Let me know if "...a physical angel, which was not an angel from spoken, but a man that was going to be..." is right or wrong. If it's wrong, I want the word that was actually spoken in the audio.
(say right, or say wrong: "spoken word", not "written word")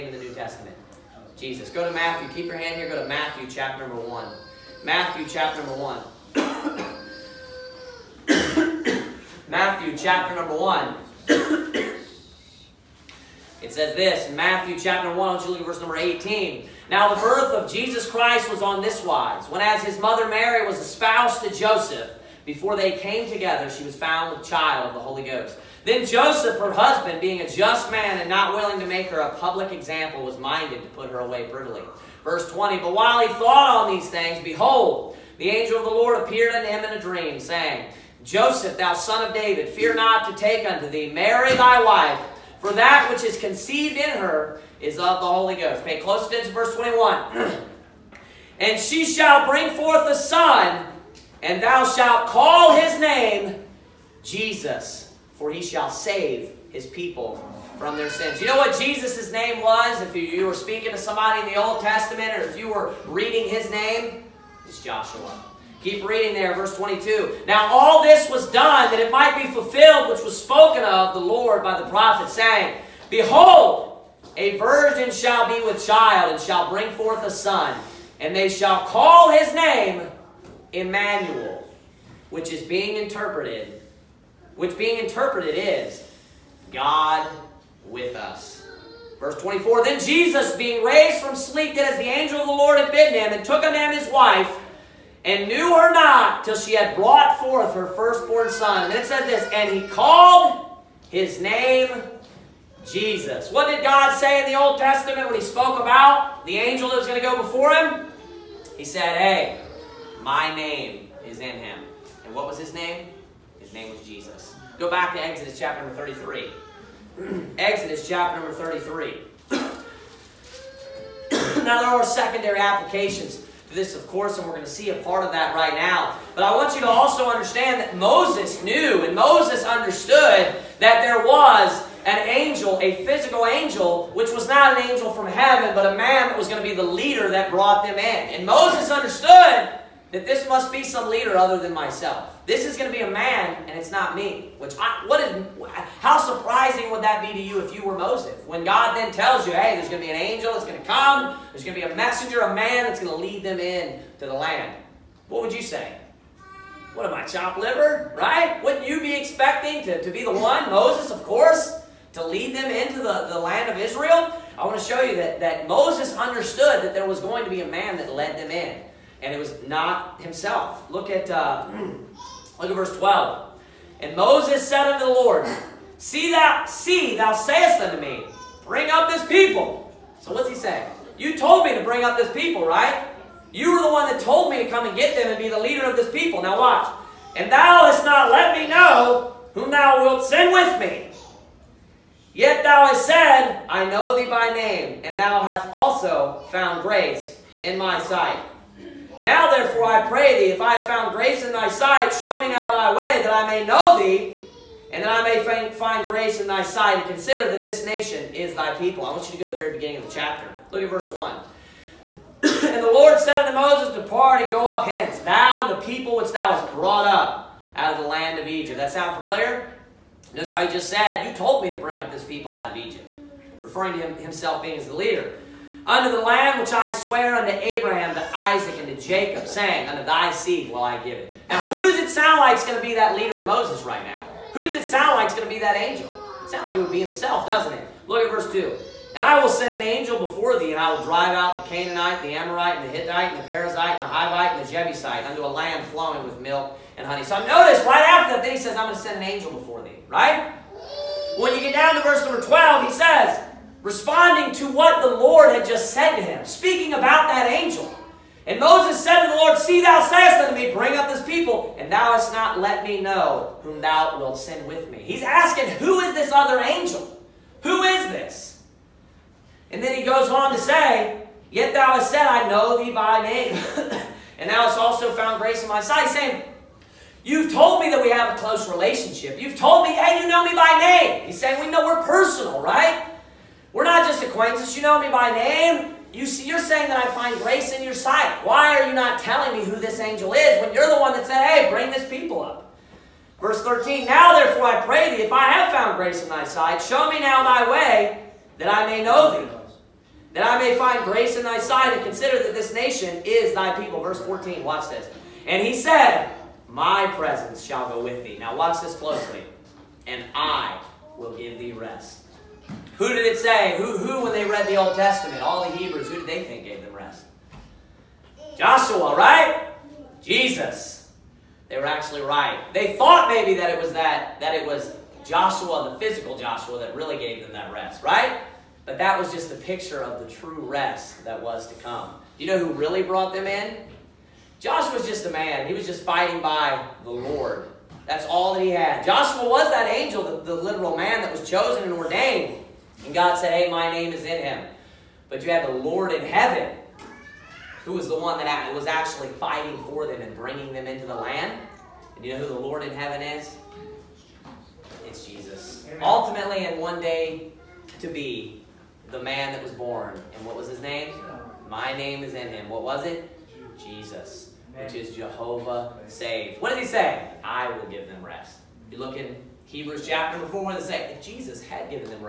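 wrong: "heaven", not "spoken".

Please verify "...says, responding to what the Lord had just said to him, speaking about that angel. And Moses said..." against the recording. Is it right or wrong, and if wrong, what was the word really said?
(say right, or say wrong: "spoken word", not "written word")
right.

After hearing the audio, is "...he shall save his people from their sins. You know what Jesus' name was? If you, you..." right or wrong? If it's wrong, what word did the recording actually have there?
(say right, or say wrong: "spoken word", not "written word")
right.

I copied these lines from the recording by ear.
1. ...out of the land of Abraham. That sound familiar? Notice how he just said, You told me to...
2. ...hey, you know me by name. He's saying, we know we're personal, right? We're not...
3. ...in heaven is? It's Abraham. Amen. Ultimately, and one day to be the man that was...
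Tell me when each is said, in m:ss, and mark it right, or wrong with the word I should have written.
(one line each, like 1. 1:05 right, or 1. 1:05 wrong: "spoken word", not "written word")
1. 3:37 wrong: "Egypt", not "Abraham"
2. 4:39 right
3. 5:52 wrong: "Jesus", not "Abraham".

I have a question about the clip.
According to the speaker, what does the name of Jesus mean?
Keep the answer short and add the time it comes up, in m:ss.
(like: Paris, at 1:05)
Jehovah Save, at 6:05.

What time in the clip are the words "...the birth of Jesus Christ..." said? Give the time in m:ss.
0:17.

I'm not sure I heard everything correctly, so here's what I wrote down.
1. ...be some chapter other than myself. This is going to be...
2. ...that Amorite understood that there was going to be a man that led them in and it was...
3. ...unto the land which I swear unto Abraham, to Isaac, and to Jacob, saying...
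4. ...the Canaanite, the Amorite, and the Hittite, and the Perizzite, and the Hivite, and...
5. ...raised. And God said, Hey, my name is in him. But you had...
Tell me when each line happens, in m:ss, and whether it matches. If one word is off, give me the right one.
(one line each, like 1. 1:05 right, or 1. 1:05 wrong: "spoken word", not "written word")
1. 2:20 wrong: "leader", not "chapter"
2. 2:45 wrong: "Moses", not "Amorite"
3. 3:45 right
4. 4:01 right
5. 5:41 wrong: "ordained", not "raised".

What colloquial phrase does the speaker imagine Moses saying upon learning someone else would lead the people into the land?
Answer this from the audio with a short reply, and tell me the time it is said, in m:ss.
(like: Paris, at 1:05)
What am I, chopped liver?, at 2:36.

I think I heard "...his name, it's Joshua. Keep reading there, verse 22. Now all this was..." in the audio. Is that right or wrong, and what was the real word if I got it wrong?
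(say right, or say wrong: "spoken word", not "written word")
right.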